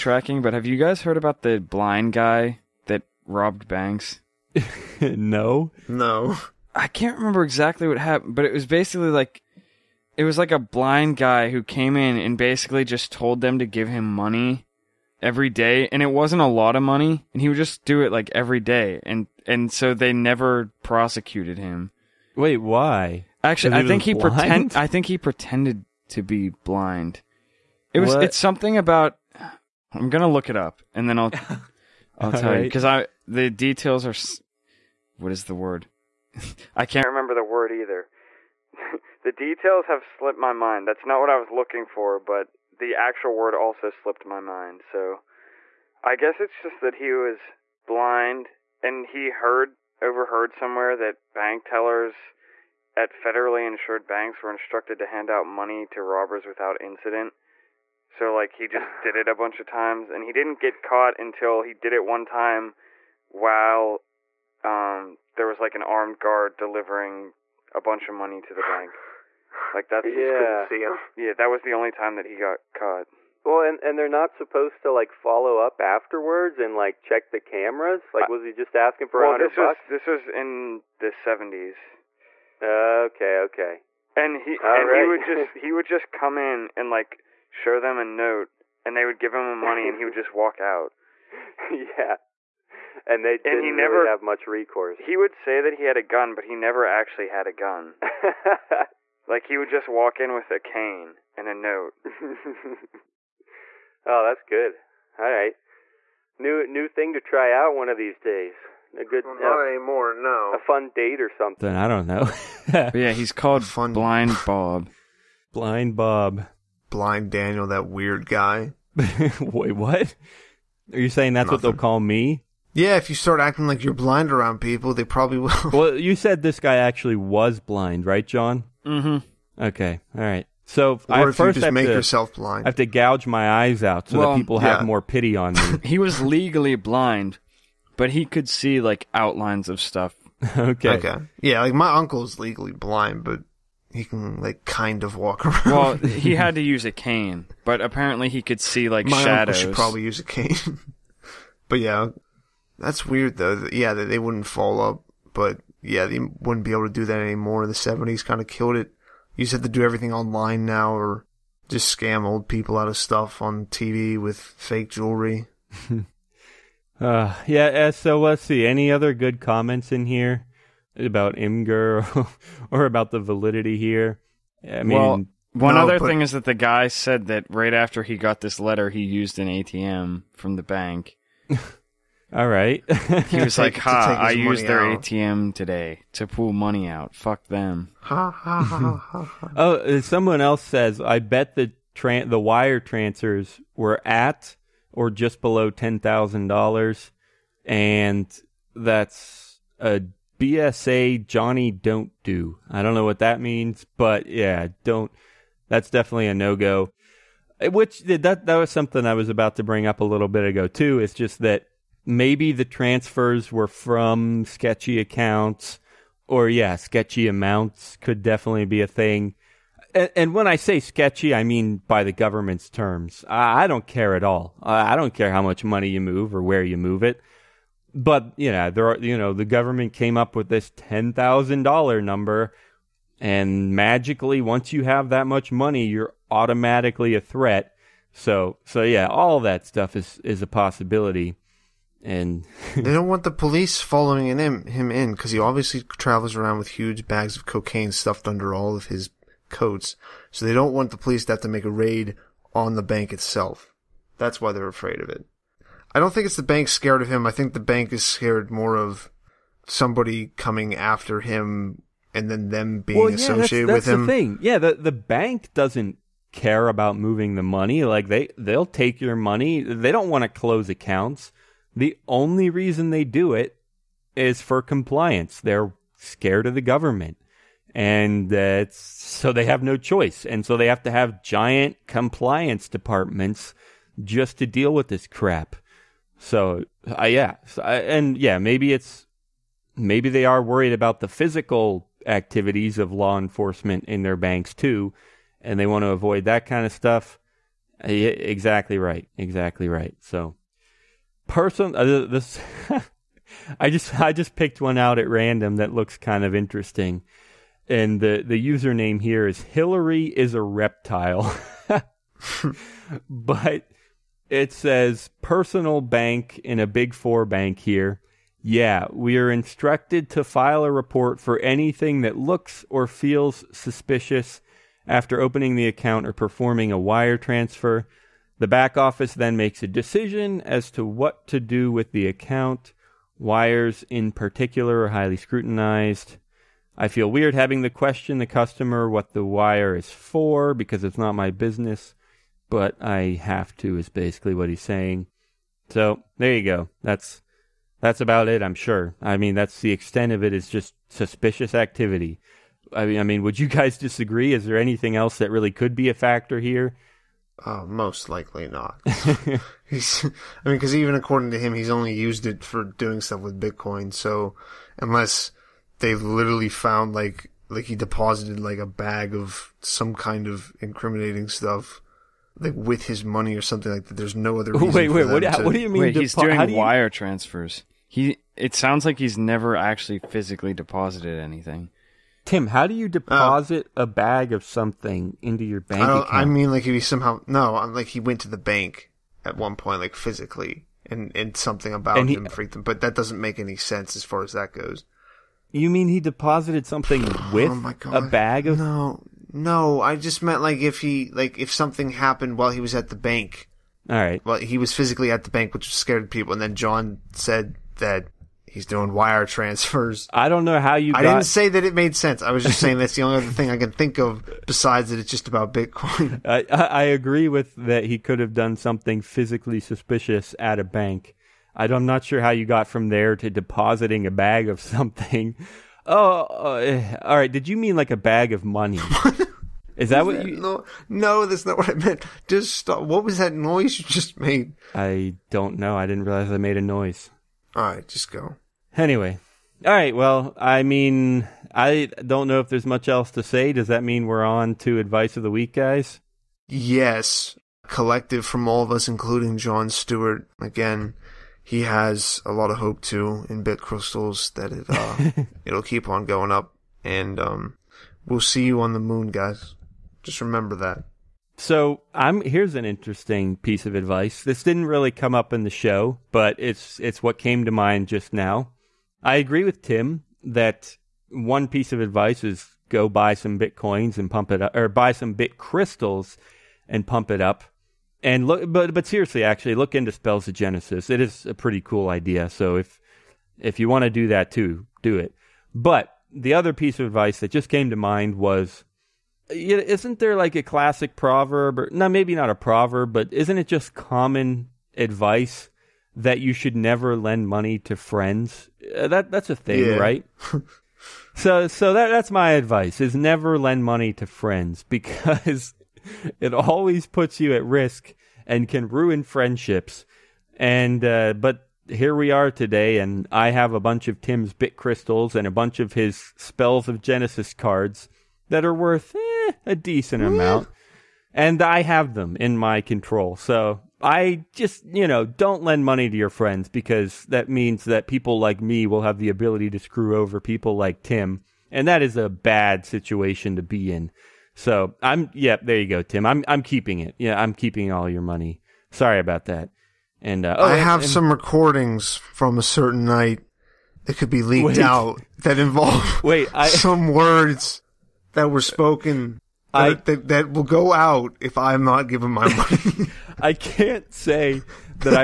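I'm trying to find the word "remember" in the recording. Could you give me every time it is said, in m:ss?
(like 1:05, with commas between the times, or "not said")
0:07, 0:37, 7:40.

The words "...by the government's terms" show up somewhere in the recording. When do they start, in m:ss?
3:41.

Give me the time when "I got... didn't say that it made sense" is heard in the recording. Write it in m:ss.
6:50.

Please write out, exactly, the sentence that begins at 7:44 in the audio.
This didn't really come up in the show, but it's it's what came to mind just now.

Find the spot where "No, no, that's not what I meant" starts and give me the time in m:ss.
7:10.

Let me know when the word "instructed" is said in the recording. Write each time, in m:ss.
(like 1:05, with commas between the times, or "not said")
0:54, 5:19.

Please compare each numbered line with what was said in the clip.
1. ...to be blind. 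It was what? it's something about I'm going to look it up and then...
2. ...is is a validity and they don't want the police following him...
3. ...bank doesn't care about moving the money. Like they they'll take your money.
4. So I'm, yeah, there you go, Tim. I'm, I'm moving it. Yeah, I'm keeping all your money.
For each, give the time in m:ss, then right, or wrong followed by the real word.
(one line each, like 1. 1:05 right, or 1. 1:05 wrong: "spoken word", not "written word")
1. 0:26 right
2. 3:59 wrong: "possibility", not "validity"
3. 4:24 right
4. 8:54 wrong: "keeping", not "moving".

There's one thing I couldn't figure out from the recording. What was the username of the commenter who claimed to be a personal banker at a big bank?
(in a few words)
Hillary is a reptile.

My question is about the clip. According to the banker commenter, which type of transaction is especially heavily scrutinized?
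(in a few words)
Wires.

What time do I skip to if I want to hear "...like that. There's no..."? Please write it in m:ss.
6:13.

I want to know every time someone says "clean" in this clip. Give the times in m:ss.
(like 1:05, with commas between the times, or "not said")
not said.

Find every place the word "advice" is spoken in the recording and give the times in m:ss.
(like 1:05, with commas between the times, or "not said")
7:24, 7:43, 7:51, 8:06, 8:14, 8:22.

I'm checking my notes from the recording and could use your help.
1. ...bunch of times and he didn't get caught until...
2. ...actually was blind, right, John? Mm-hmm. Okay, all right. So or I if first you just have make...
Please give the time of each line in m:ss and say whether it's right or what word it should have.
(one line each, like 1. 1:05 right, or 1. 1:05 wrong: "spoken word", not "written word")
1. 0:59 right
2. 2:06 right.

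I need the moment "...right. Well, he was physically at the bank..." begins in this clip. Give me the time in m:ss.
6:43.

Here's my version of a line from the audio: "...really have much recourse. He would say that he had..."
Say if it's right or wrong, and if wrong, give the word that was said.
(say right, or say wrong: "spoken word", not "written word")
right.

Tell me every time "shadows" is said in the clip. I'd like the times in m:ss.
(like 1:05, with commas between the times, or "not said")
2:29.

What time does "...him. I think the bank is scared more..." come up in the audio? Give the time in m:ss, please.
4:17.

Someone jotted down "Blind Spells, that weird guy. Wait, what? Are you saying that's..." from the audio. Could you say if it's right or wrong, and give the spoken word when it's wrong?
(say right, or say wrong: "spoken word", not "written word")
wrong: "Daniel", not "Spells".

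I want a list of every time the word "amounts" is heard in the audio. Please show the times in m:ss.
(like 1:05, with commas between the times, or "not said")
3:37, 8:40.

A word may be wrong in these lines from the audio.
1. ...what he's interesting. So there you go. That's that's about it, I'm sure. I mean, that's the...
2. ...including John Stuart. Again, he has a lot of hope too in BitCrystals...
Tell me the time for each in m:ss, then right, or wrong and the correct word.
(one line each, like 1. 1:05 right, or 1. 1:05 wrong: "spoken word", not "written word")
1. 5:44 wrong: "saying", not "interesting"
2. 7:28 right.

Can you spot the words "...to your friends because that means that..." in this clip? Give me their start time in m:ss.
8:45.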